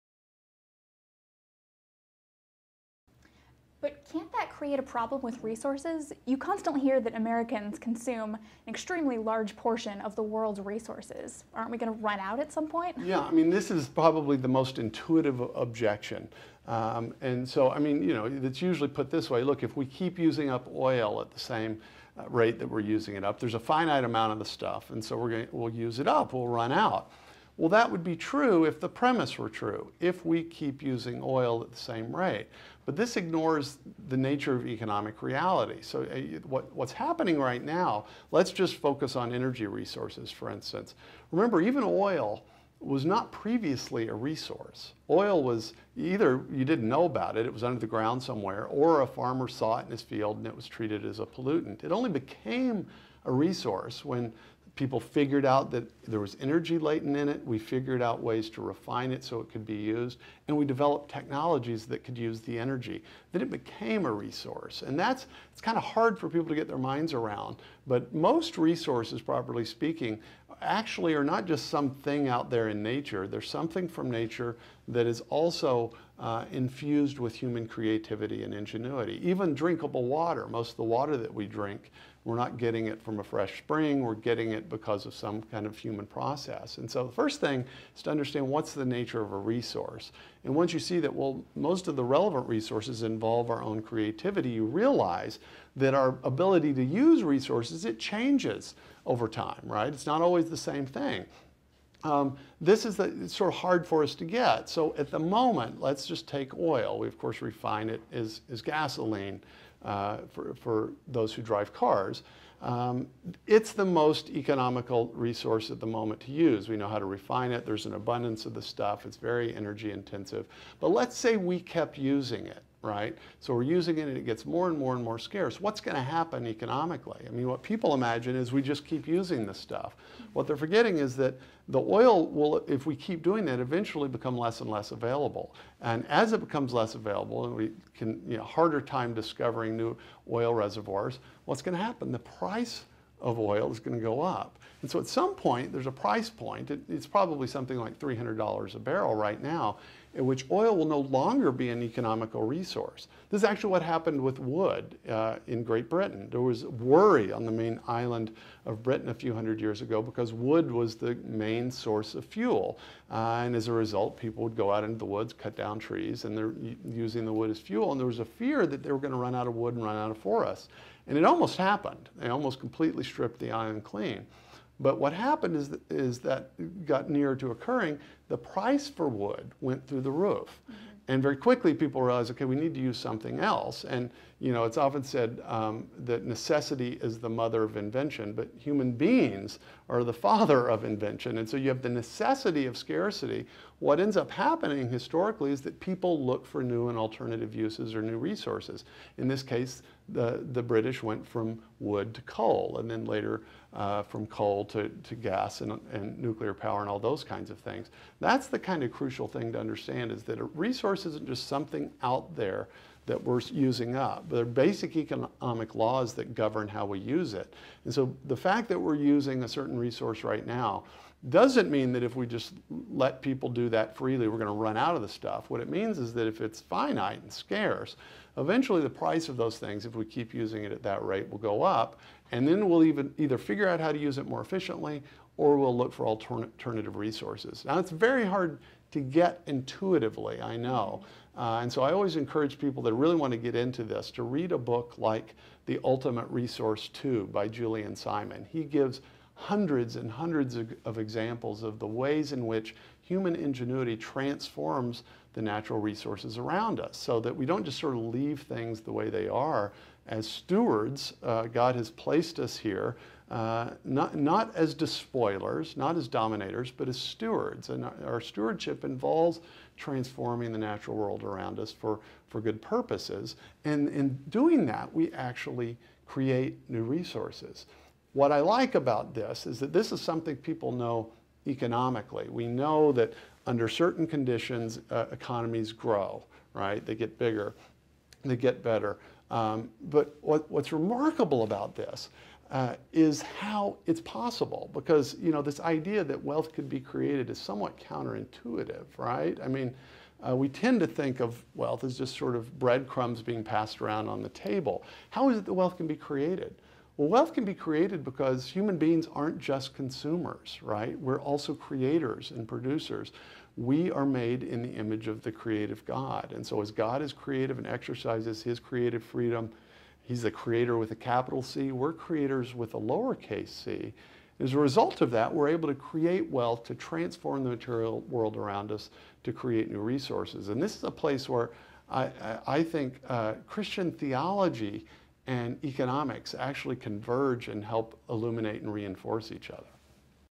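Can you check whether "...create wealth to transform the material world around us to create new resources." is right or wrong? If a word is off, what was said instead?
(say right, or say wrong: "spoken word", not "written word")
right.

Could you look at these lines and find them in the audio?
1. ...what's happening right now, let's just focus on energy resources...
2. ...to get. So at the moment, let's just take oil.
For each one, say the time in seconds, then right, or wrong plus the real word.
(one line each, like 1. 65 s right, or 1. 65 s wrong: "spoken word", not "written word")
1. 36 s right
2. 104 s right.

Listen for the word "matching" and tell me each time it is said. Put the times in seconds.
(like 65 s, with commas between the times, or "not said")
not said.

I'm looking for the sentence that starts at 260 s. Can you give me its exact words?
As stewards, uh, God has placed us here, uh, not, not as despoilers, not as dominators, but as stewards.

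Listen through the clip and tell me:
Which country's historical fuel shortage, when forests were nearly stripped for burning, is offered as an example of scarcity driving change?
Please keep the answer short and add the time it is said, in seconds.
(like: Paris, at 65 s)
Great Britain, at 155 s.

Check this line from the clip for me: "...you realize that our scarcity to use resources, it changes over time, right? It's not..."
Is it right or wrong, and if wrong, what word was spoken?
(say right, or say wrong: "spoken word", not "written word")
wrong: "ability", not "scarcity".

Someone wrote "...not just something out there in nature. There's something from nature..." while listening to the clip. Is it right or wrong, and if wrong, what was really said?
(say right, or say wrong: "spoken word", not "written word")
right.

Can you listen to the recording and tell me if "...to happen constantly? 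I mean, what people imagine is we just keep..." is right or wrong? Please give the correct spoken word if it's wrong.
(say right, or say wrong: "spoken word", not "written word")
wrong: "economically", not "constantly".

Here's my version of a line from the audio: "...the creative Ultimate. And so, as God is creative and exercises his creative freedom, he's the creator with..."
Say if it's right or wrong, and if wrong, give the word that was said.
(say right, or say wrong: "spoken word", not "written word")
wrong: "God", not "Ultimate".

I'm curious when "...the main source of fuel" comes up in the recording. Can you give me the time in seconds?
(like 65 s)
160 s.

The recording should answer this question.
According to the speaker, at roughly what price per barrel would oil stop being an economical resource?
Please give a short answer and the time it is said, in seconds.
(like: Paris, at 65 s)
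$300, at 147 s.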